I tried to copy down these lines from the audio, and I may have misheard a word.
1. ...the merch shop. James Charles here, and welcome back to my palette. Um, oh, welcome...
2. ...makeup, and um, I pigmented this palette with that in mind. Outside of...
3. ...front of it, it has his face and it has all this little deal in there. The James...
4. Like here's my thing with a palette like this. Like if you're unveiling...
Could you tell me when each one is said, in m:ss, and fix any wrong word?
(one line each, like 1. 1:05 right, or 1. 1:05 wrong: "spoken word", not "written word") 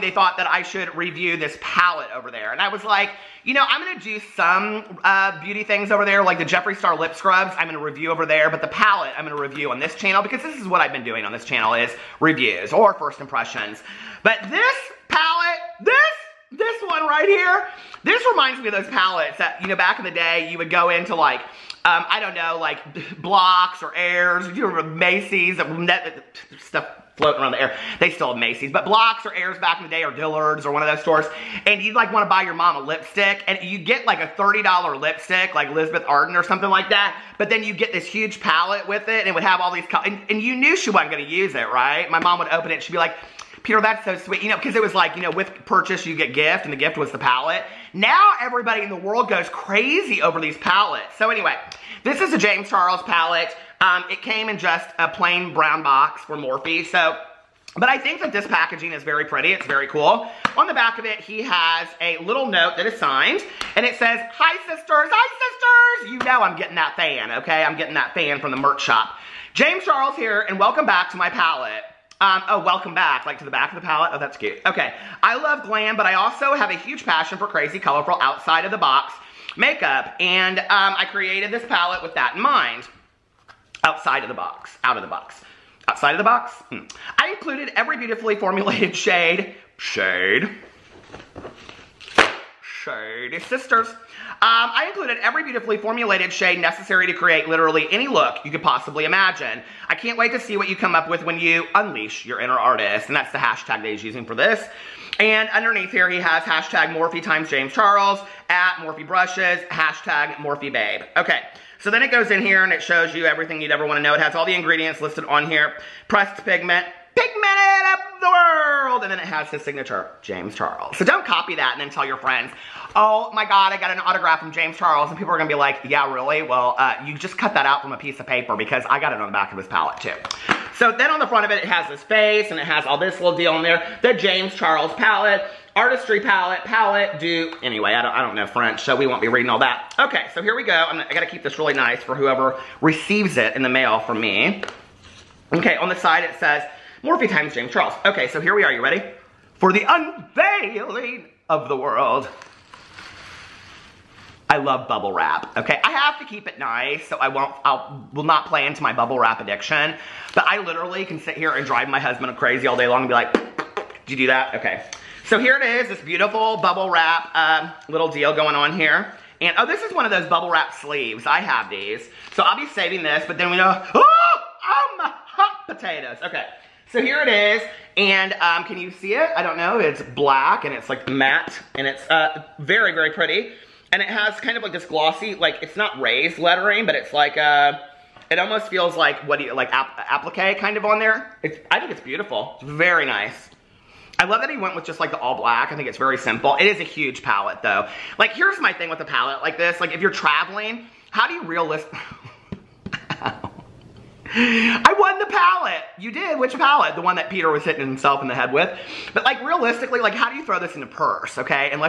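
1. 1:08 right
2. 1:19 wrong: "created", not "pigmented"
3. 2:11 right
4. 3:18 wrong: "traveling", not "unveiling".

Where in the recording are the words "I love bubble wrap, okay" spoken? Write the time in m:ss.
2:34.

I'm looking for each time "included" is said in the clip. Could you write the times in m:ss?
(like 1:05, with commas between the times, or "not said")
1:27, 1:34.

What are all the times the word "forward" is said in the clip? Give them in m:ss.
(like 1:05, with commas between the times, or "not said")
not said.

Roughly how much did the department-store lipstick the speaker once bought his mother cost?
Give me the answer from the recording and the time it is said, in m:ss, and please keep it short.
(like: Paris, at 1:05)
$30, at 0:34.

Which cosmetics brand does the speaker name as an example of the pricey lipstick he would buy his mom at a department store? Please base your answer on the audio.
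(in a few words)
Elizabeth Arden.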